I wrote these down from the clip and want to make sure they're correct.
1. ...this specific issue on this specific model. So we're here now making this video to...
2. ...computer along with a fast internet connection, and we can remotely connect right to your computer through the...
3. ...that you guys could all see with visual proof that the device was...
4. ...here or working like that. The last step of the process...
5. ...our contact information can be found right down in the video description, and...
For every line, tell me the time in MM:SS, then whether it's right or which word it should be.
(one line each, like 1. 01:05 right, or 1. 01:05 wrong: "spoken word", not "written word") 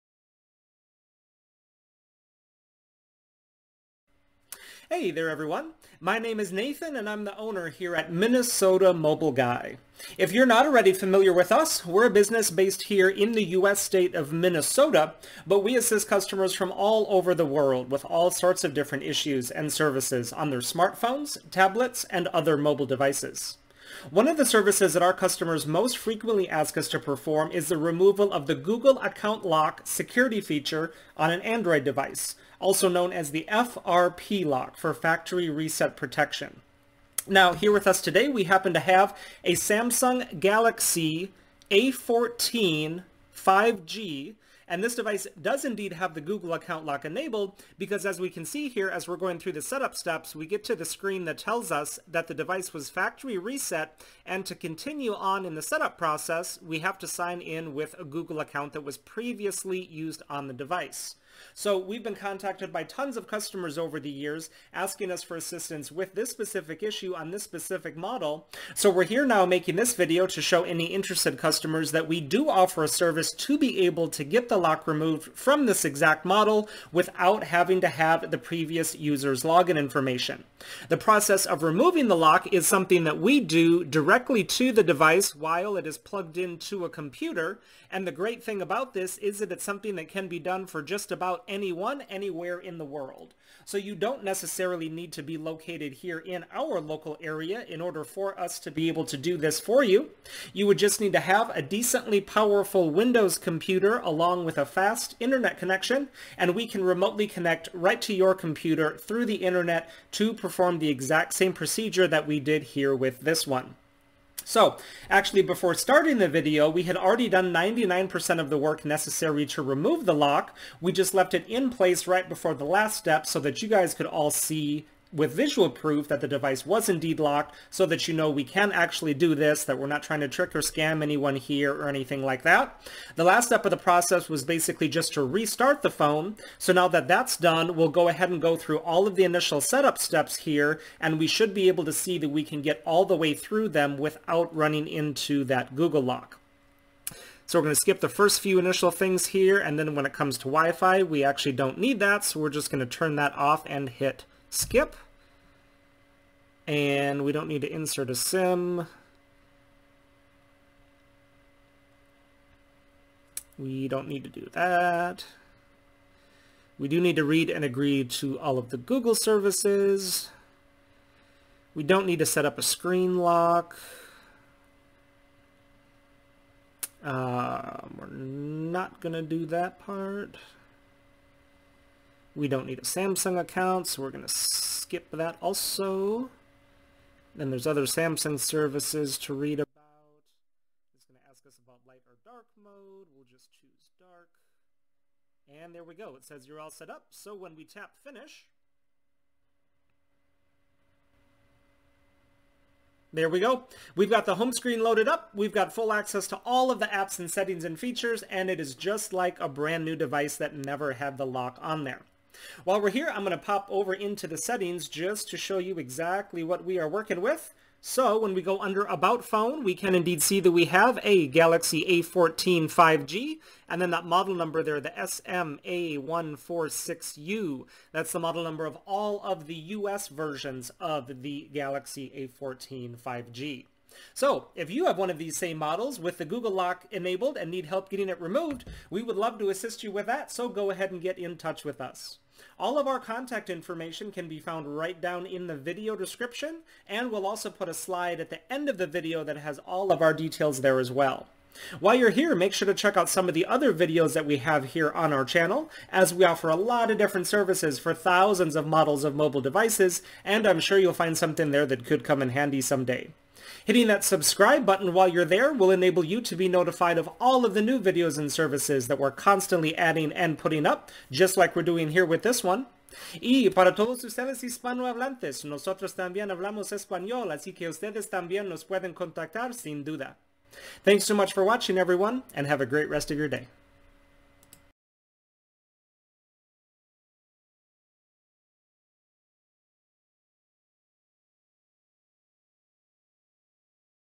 1. 01:06 right
2. 01:43 right
3. 02:03 right
4. 02:11 wrong: "anything", not "working"
5. 04:02 right.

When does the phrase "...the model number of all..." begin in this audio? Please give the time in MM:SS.
03:48.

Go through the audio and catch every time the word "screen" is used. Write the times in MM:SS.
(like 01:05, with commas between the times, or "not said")
00:50, 02:52, 03:24.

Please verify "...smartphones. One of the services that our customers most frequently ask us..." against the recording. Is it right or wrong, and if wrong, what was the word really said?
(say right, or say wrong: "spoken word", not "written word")
wrong: "devices", not "smartphones".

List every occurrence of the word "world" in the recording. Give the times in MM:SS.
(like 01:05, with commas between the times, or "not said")
00:17, 01:32.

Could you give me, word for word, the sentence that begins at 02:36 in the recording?
And we don't need to insert a sim.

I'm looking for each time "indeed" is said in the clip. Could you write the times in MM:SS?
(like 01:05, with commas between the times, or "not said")
00:45, 02:06, 03:39.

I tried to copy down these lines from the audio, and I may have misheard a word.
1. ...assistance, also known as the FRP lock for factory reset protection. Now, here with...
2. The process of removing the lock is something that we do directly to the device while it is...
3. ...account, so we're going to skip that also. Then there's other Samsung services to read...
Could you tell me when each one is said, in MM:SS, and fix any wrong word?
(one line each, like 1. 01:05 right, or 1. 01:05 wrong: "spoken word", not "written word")
1. 00:31 wrong: "device", not "assistance"
2. 01:20 right
3. 03:03 right.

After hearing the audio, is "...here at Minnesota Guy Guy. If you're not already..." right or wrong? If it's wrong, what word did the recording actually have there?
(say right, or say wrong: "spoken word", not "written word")
wrong: "Mobile", not "Guy".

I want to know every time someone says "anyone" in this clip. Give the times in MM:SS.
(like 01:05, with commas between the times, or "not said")
01:31, 02:11.